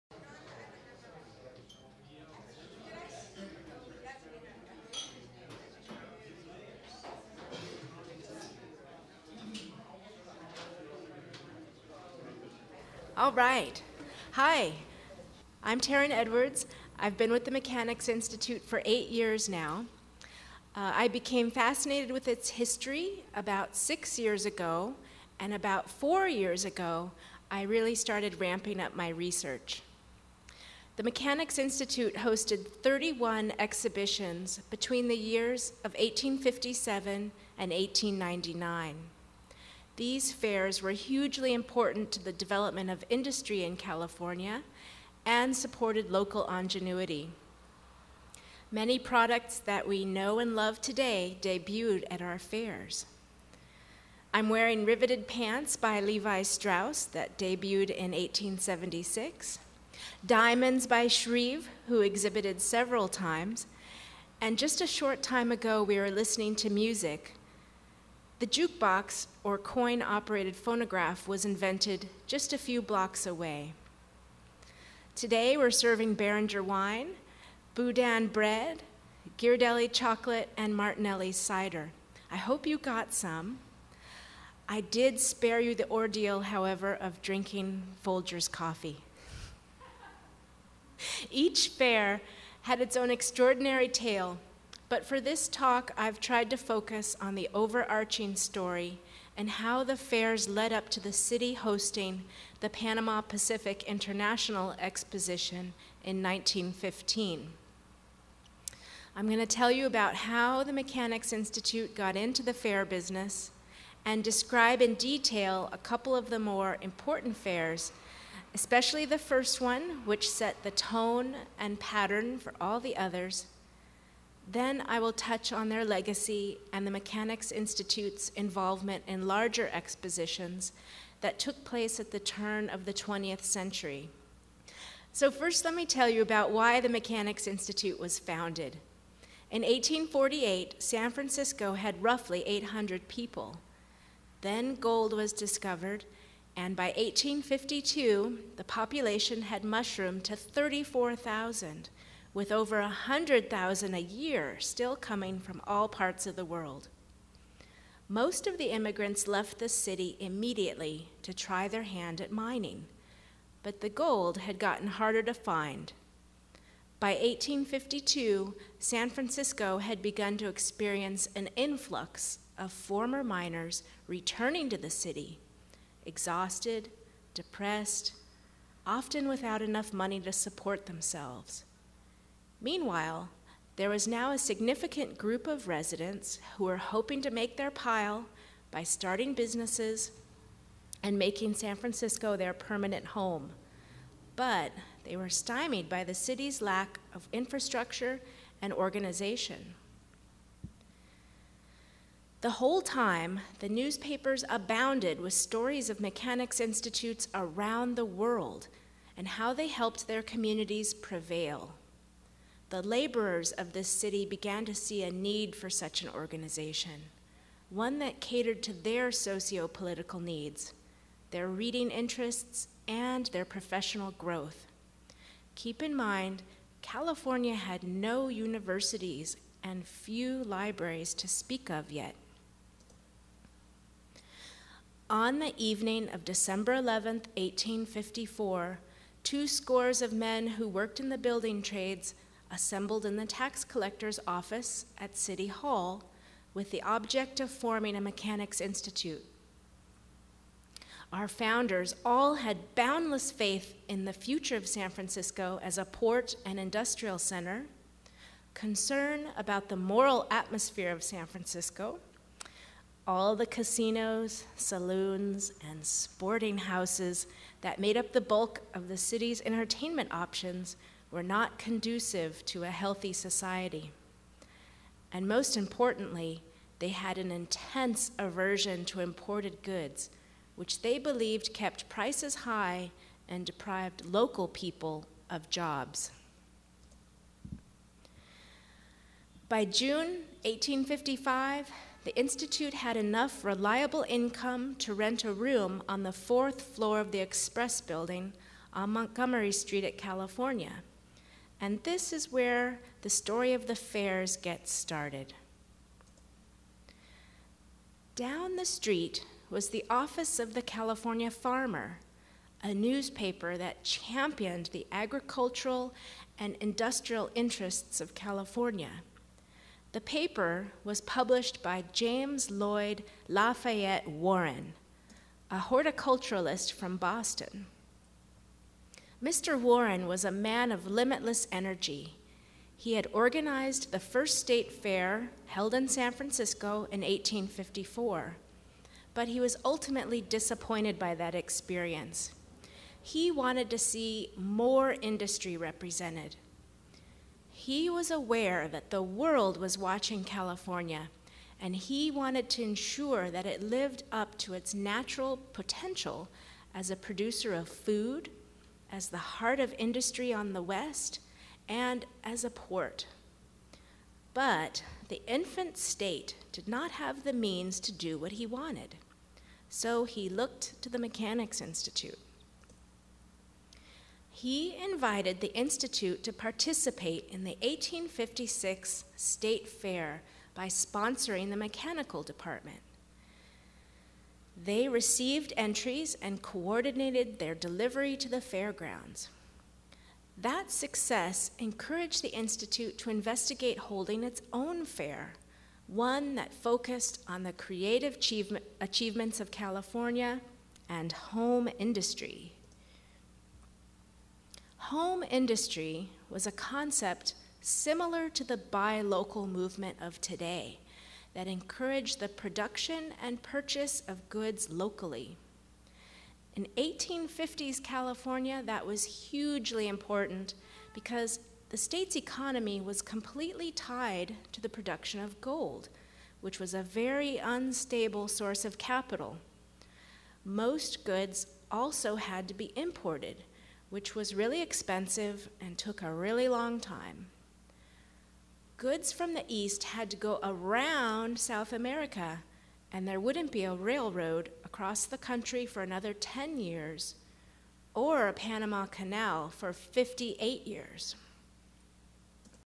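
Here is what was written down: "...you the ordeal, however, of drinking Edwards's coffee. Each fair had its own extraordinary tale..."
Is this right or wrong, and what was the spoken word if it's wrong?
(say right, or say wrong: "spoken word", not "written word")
wrong: "Folger", not "Edwards".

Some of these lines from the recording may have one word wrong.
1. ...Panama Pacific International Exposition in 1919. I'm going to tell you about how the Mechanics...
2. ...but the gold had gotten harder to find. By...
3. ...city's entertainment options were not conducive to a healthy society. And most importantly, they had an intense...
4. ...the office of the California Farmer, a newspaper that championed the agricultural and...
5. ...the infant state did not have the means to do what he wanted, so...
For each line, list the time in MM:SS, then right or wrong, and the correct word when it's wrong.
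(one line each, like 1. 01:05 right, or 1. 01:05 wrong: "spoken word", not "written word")
1. 01:42 wrong: "1915", not "1919"
2. 02:43 right
3. 04:28 right
4. 05:09 right
5. 06:05 right.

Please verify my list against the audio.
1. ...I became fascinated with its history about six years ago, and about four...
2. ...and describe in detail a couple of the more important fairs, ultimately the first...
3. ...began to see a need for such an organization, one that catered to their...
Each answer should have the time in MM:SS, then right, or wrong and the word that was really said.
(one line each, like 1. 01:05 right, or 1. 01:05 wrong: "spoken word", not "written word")
1. 00:20 right
2. 01:54 wrong: "especially", not "ultimately"
3. 03:34 right.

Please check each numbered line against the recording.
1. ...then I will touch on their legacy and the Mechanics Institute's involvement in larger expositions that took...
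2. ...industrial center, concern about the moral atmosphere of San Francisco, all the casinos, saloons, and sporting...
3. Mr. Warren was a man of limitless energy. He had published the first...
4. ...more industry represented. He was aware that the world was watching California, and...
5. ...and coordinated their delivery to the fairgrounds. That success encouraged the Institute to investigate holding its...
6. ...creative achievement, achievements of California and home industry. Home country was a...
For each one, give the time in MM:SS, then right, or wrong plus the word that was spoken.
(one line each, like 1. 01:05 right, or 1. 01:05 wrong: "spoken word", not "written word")
1. 02:04 right
2. 04:16 right
3. 05:29 wrong: "organized", not "published"
4. 05:44 right
5. 06:26 right
6. 06:37 wrong: "industry", not "country".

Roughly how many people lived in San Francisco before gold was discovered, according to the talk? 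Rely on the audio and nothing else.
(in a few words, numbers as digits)
800.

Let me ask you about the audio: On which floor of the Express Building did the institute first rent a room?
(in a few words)
fourth floor.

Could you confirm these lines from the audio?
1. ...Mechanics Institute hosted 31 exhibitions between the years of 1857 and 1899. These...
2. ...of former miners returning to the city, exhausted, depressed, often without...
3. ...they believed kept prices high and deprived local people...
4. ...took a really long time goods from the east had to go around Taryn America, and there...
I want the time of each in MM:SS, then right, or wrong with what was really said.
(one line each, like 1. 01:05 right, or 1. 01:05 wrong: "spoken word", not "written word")
1. 00:31 right
2. 02:52 right
3. 04:40 right
4. 07:15 wrong: "South", not "Taryn".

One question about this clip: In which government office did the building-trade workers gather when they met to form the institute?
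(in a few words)
the tax collector's office.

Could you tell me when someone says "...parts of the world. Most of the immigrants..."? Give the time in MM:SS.
02:35.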